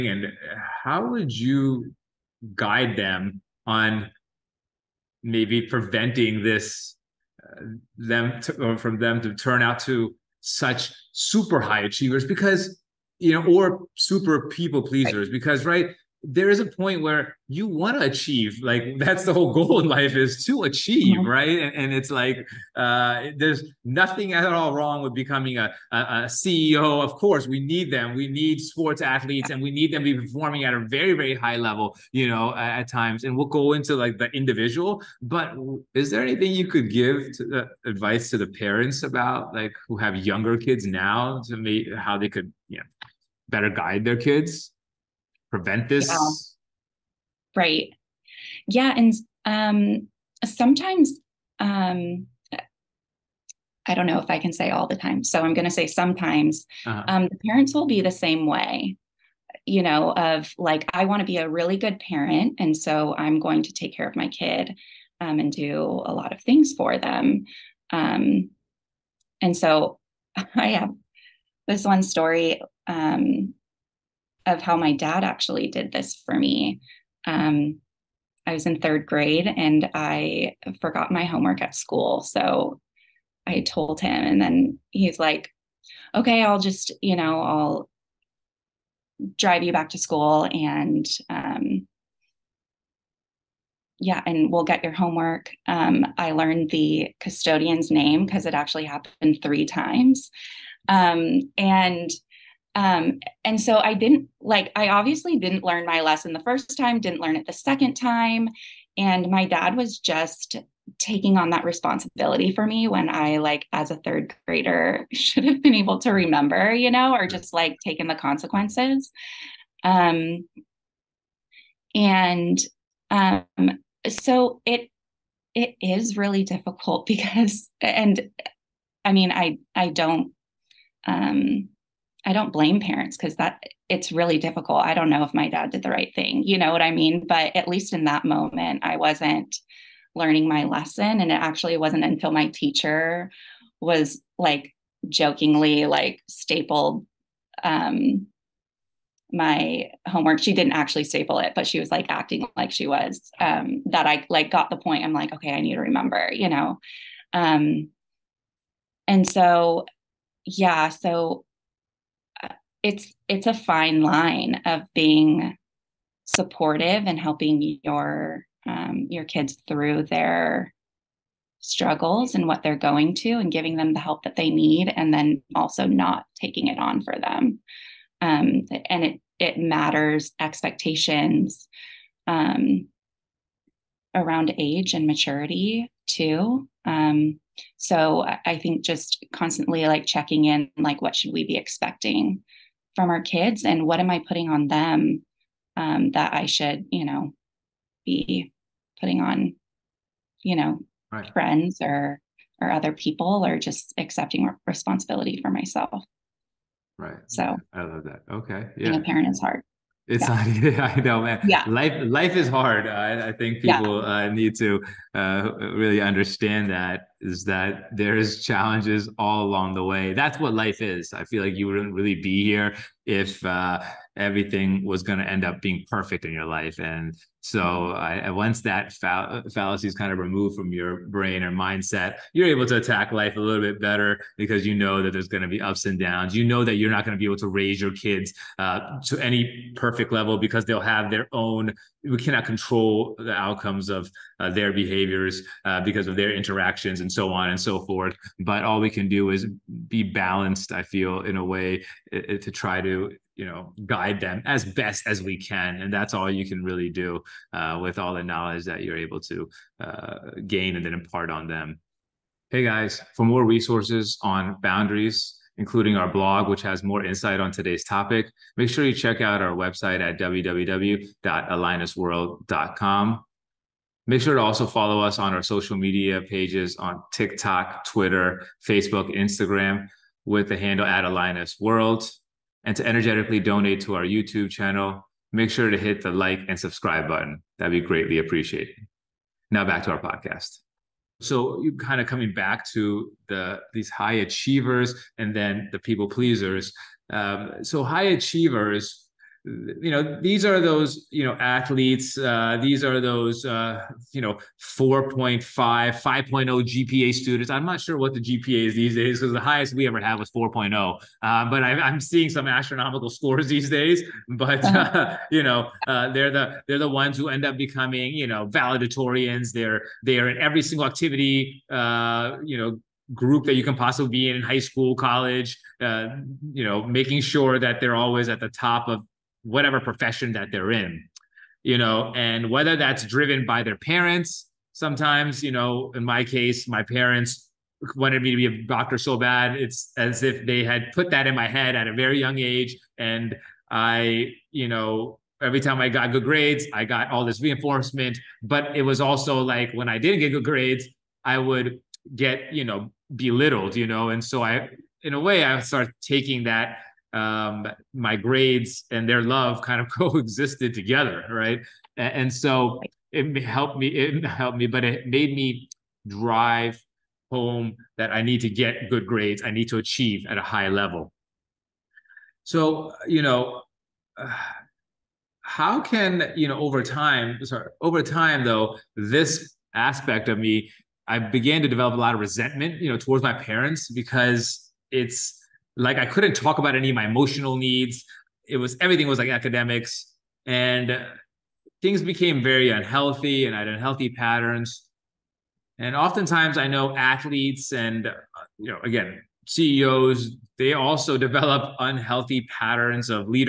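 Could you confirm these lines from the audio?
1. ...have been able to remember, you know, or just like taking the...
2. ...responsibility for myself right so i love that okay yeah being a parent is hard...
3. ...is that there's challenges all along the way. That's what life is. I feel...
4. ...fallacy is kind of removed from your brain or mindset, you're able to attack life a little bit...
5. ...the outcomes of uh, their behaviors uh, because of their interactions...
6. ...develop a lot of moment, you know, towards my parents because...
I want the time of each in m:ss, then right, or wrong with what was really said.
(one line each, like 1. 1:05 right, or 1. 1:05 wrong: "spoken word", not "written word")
1. 1:55 right
2. 3:24 right
3. 3:37 right
4. 3:49 right
5. 4:03 right
6. 6:21 wrong: "resentment", not "moment".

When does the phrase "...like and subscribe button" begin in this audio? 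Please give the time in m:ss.
4:46.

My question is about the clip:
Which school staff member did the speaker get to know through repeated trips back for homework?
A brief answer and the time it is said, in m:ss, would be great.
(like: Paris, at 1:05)
the custodian, at 1:36.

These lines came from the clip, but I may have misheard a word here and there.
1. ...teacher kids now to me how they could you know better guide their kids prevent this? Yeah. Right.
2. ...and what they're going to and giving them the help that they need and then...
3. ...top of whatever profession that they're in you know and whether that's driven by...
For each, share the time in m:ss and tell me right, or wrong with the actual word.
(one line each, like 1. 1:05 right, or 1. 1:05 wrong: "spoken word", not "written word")
1. 0:40 wrong: "younger", not "teacher"
2. 2:52 right
3. 5:28 right.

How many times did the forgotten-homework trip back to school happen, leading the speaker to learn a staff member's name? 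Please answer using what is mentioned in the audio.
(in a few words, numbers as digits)
3.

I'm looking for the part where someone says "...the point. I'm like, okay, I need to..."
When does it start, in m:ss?
2:34.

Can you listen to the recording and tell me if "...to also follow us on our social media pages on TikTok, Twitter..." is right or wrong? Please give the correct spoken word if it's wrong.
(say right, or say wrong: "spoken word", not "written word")
right.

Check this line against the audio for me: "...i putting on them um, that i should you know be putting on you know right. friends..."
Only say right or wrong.
right.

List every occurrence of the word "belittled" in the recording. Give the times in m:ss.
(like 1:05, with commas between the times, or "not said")
5:53.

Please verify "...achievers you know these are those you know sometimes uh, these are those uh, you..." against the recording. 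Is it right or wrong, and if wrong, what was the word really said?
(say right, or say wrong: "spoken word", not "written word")
wrong: "athletes", not "sometimes".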